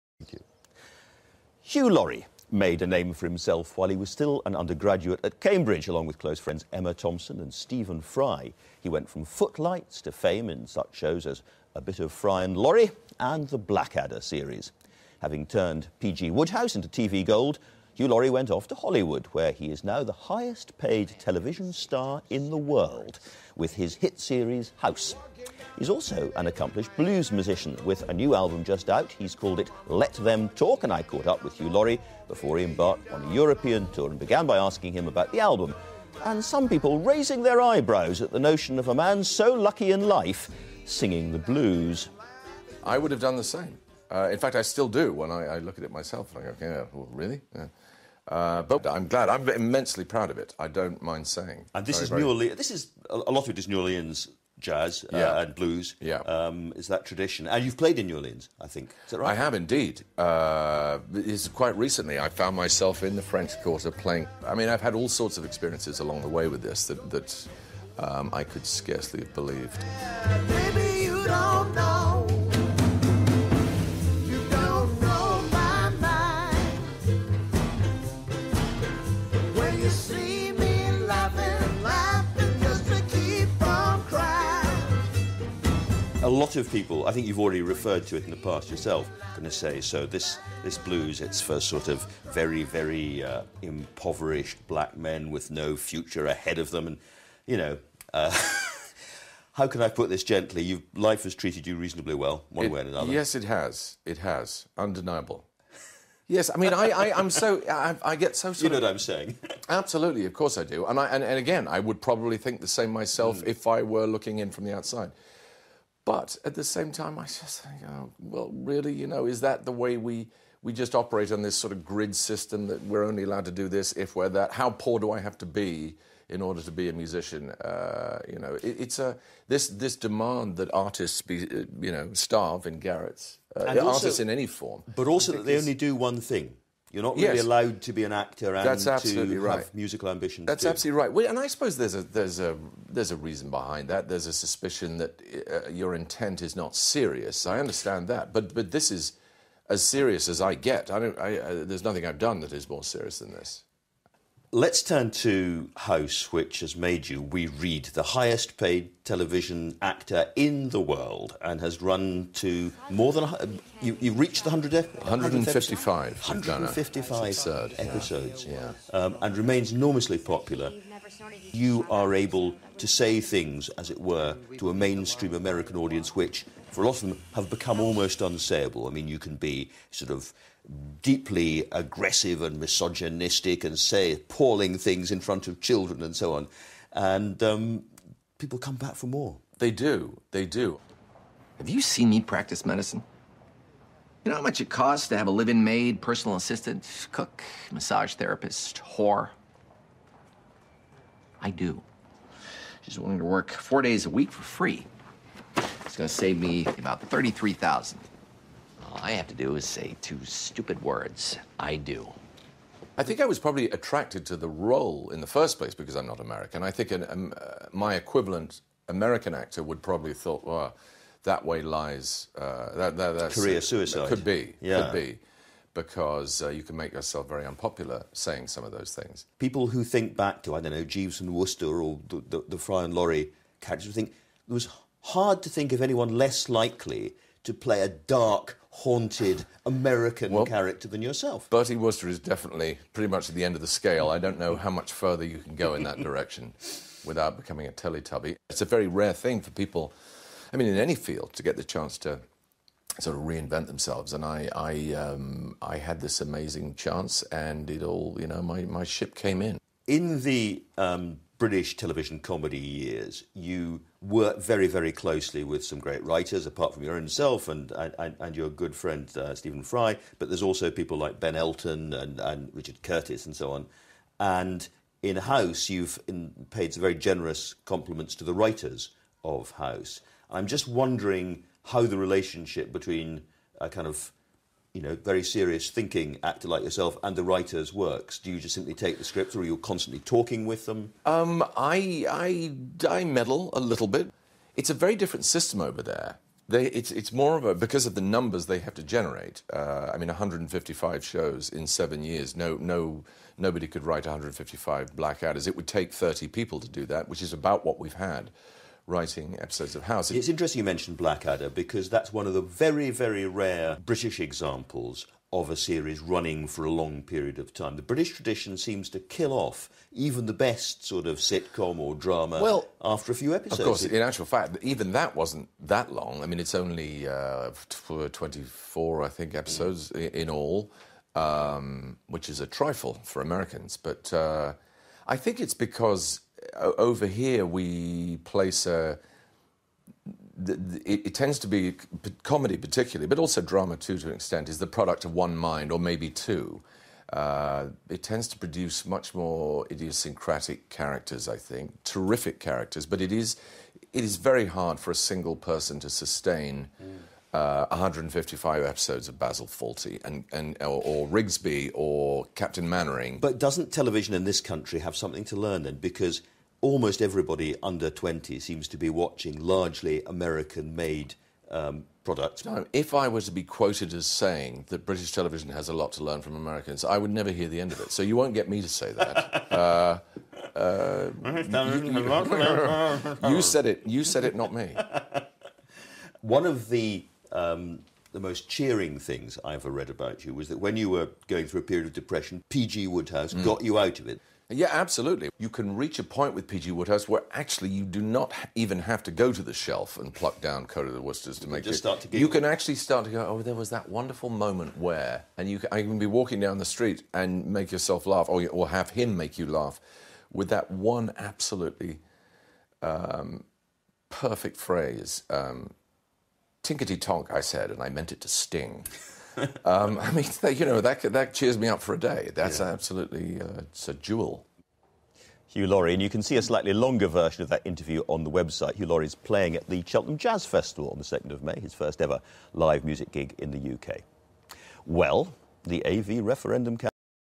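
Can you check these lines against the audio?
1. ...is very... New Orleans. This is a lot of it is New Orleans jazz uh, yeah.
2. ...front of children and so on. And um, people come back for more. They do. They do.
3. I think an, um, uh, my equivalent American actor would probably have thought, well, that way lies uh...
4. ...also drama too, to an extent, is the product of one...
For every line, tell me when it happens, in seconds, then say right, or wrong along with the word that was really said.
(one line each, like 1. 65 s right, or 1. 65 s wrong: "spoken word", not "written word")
1. 52 s right
2. 185 s right
3. 216 s right
4. 343 s right.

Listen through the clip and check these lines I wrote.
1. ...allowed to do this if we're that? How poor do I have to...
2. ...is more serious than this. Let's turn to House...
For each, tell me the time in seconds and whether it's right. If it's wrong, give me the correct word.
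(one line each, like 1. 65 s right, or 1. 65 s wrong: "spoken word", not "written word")
1. 123 s right
2. 152 s right.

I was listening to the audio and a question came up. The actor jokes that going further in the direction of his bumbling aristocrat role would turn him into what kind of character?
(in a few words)
Teletubby.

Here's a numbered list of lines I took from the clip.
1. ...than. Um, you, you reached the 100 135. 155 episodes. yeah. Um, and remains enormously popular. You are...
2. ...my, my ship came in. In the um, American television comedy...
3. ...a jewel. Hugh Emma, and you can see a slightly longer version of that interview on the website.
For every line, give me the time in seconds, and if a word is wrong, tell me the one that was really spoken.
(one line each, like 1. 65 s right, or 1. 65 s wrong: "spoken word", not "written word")
1. 163 s wrong: "155", not "135"
2. 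258 s wrong: "British", not "American"
3. 423 s wrong: "Laurie", not "Emma".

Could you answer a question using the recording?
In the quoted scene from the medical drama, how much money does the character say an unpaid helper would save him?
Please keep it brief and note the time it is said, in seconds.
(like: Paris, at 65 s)
33,000, at 207 s.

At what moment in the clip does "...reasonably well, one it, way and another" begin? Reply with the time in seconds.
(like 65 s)
101 s.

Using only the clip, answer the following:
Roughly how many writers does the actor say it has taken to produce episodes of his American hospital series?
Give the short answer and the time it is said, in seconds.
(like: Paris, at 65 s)
30, at 305 s.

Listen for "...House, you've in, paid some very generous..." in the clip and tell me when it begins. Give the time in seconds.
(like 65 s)
275 s.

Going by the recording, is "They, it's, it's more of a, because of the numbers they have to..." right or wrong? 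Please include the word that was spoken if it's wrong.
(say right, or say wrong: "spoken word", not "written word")
right.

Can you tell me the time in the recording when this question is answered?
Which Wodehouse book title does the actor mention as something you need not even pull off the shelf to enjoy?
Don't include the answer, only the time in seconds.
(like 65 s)
400 s.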